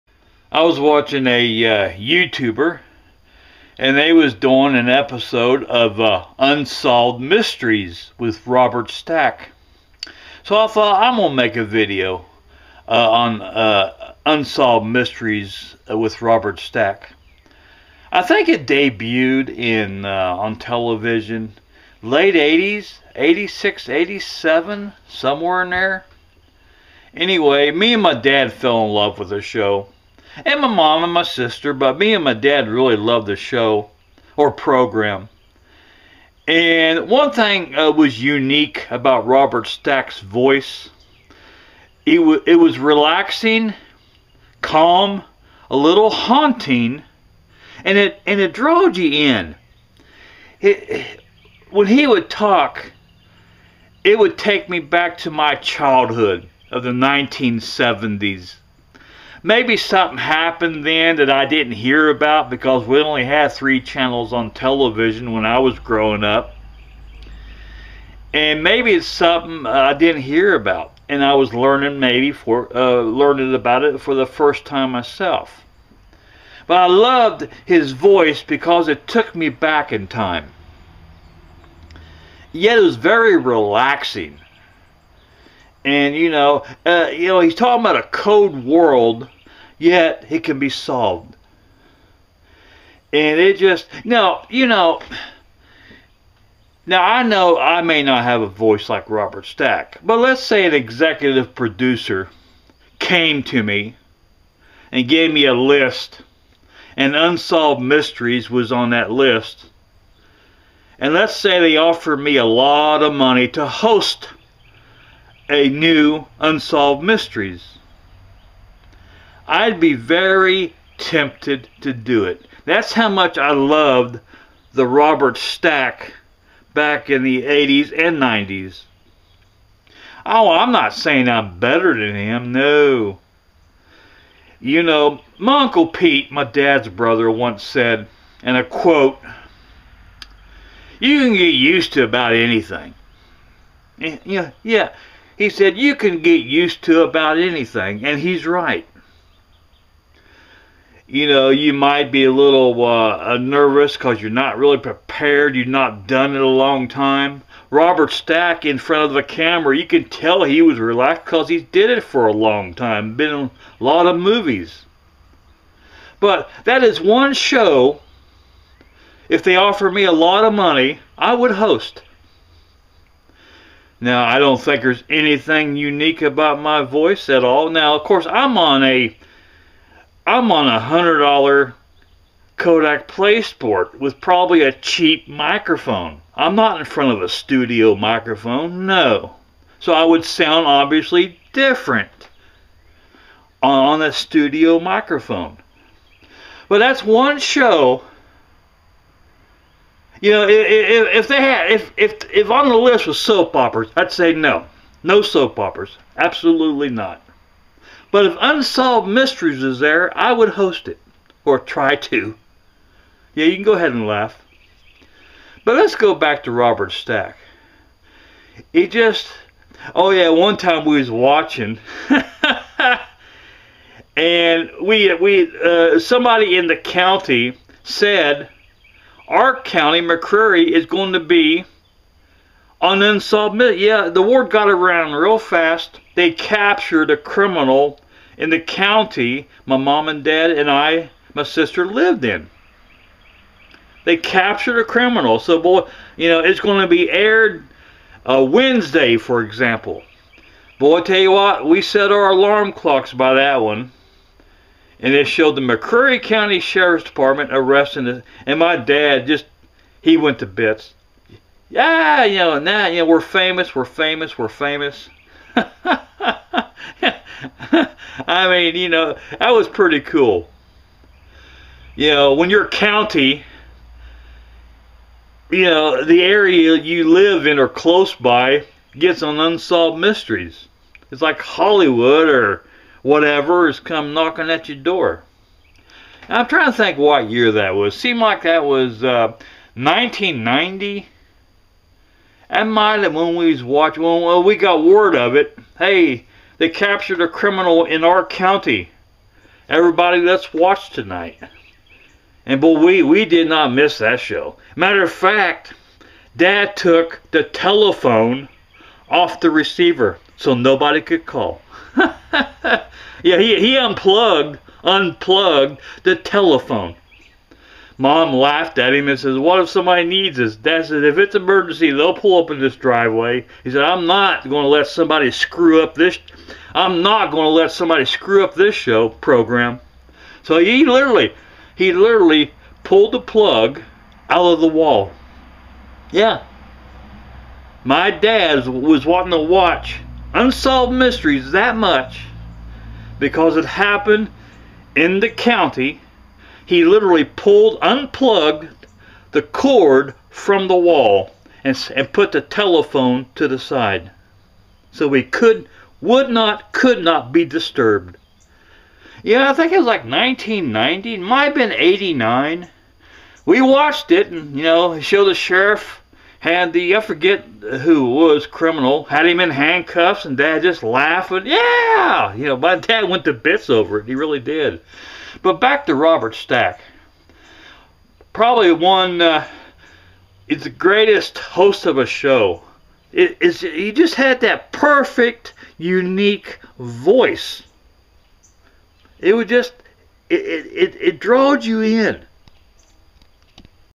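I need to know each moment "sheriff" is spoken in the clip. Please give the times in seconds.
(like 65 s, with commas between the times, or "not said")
256 s, 365 s.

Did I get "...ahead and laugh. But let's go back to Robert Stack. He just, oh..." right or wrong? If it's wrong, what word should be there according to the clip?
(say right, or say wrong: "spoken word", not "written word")
right.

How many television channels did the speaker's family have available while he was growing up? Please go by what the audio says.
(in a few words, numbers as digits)
3.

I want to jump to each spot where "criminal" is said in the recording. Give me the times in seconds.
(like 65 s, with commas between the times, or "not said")
237 s, 244 s, 297 s, 368 s.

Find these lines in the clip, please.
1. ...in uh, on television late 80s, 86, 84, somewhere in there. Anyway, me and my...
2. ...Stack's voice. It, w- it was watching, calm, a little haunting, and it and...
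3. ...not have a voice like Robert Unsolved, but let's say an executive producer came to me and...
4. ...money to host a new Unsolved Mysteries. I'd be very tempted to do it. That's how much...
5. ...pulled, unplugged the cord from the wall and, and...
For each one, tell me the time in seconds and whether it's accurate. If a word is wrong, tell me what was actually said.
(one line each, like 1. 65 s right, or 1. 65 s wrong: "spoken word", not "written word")
1. 19 s wrong: "87", not "84"
2. 39 s wrong: "relaxing", not "watching"
3. 98 s wrong: "Stack", not "Unsolved"
4. 113 s right
5. 347 s right.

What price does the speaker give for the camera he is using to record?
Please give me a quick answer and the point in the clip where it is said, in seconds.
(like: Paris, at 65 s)
$100, at 180 s.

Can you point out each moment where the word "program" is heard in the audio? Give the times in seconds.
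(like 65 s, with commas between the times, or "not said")
34 s, 329 s.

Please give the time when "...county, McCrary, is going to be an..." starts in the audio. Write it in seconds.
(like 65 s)
229 s.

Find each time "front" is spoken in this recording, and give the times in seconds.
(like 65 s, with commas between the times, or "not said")
158 s, 186 s.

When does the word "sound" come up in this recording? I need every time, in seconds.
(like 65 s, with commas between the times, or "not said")
190 s.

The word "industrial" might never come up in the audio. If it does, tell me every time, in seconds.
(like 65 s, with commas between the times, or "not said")
not said.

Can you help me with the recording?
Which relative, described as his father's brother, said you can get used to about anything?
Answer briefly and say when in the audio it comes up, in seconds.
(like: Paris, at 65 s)
Uncle Pete, at 135 s.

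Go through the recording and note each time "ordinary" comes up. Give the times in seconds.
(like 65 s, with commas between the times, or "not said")
not said.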